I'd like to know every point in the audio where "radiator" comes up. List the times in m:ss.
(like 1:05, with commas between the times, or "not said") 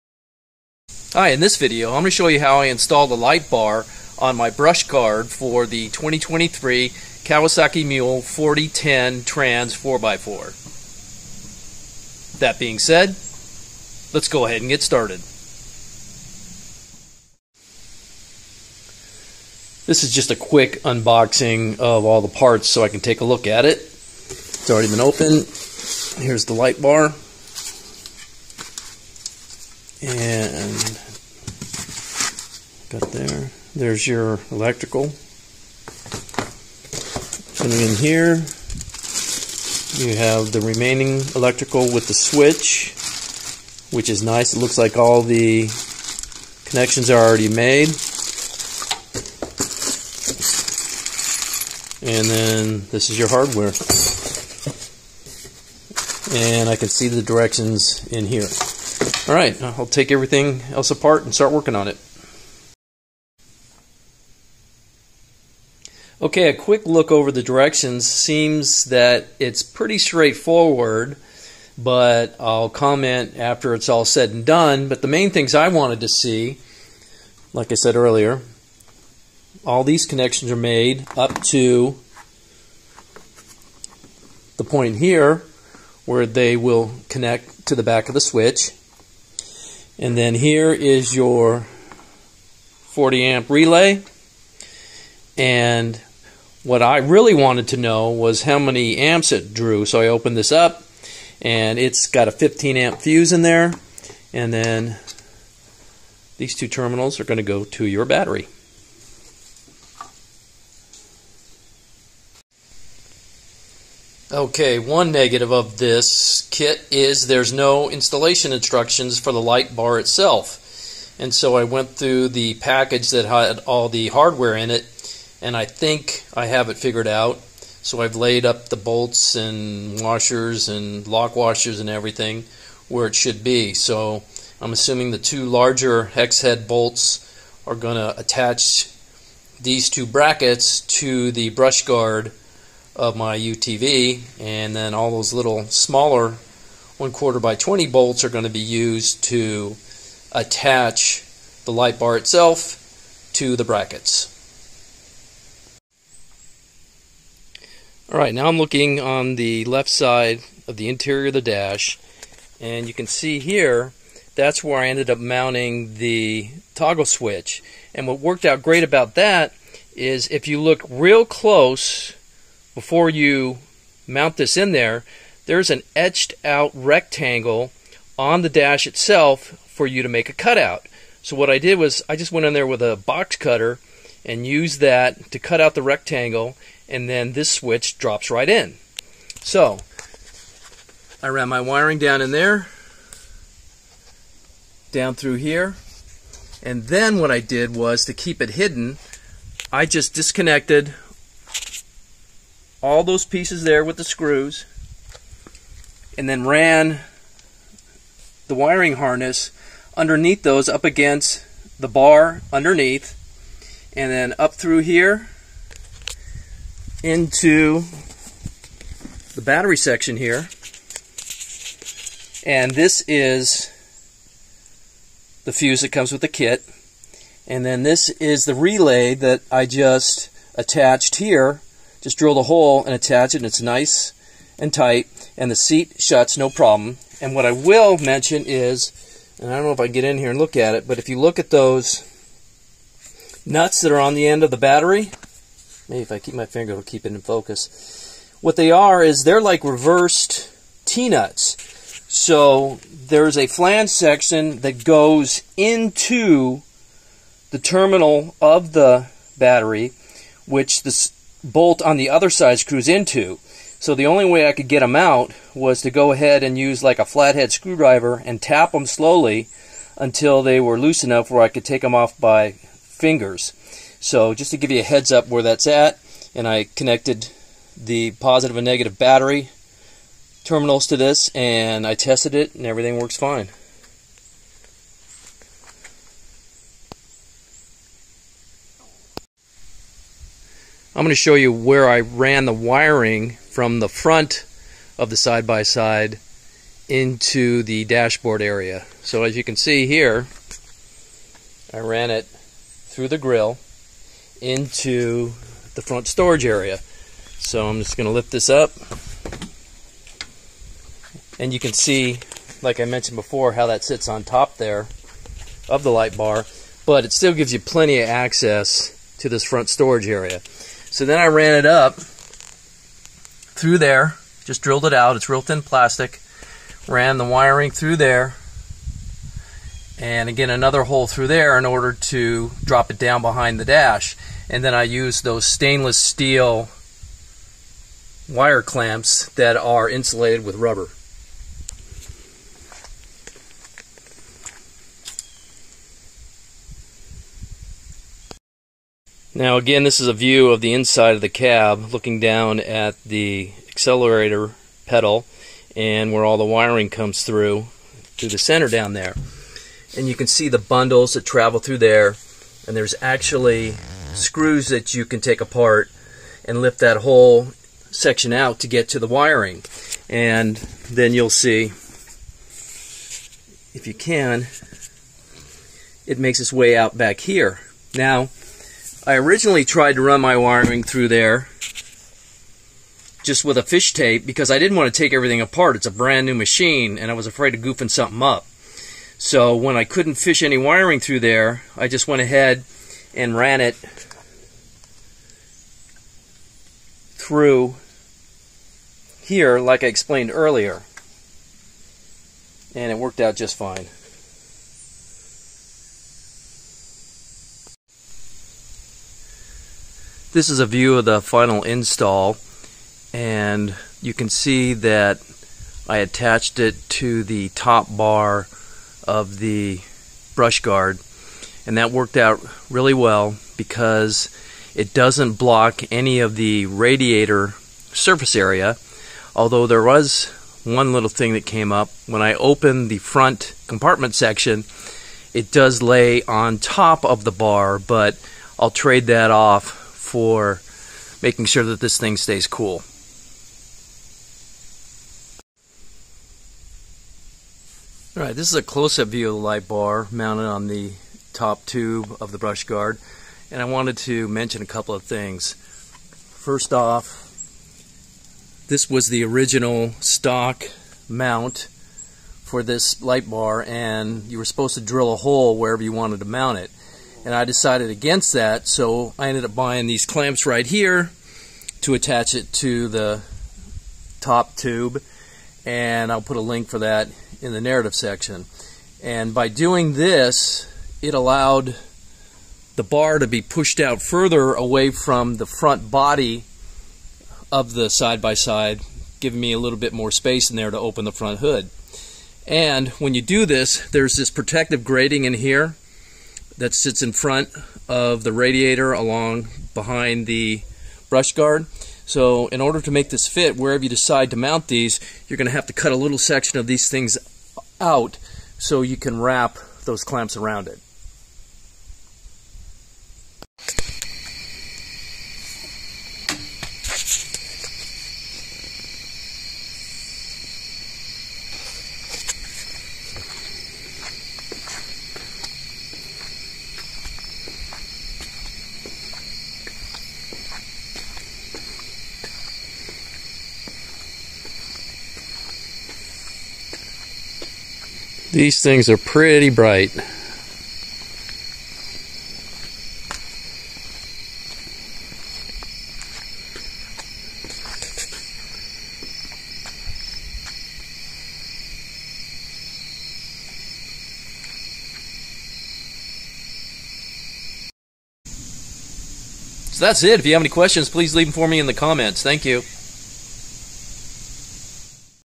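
7:06, 8:18.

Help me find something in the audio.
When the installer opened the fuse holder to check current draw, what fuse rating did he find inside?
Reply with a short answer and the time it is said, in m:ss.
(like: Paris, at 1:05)
15 amp, at 1:42.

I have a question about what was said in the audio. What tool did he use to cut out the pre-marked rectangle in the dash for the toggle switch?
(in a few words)
box cutter.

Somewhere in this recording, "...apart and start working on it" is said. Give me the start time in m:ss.
1:00.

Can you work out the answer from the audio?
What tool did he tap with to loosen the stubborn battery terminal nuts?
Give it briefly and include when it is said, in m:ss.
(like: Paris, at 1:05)
flathead screwdriver, at 4:27.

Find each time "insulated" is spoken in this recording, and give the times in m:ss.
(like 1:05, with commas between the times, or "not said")
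5:39.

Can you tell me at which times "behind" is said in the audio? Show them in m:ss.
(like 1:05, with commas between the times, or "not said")
5:33, 8:19.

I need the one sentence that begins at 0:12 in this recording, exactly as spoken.
That being said, let's go ahead and get started.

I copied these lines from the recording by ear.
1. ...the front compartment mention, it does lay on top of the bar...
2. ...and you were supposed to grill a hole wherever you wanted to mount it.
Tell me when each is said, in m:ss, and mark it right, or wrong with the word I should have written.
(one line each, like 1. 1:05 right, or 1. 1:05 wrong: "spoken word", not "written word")
1. 7:12 wrong: "section", not "mention"
2. 7:43 wrong: "drill", not "grill".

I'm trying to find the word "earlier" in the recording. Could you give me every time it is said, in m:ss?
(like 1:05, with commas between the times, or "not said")
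1:17, 6:40.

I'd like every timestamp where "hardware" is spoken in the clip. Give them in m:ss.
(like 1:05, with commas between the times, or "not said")
0:53, 2:04.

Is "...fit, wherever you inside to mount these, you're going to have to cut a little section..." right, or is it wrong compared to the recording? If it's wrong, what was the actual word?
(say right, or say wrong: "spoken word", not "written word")
wrong: "decide", not "inside".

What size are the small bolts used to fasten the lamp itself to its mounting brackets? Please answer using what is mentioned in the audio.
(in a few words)
1/4 by 20.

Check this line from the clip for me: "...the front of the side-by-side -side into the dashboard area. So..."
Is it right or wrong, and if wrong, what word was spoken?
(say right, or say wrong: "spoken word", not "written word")
right.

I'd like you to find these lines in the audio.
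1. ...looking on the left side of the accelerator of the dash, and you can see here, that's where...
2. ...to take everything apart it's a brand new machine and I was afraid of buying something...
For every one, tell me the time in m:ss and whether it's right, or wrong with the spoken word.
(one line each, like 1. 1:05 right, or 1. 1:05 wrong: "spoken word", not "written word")
1. 2:38 wrong: "interior", not "accelerator"
2. 6:24 wrong: "goofing", not "buying".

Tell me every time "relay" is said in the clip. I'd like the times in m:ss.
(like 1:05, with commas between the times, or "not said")
1:33, 3:48.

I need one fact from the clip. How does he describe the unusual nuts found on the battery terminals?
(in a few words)
reversed T-nuts.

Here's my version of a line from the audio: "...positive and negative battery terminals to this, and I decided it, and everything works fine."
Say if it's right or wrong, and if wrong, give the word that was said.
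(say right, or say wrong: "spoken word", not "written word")
wrong: "tested", not "decided".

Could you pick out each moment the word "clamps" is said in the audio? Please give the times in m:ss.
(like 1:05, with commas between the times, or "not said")
5:38, 7:50, 8:30.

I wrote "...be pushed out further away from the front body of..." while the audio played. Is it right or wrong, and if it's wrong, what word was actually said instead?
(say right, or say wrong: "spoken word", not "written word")
right.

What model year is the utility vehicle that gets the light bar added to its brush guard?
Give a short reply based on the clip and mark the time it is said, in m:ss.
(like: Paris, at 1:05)
2023, at 0:05.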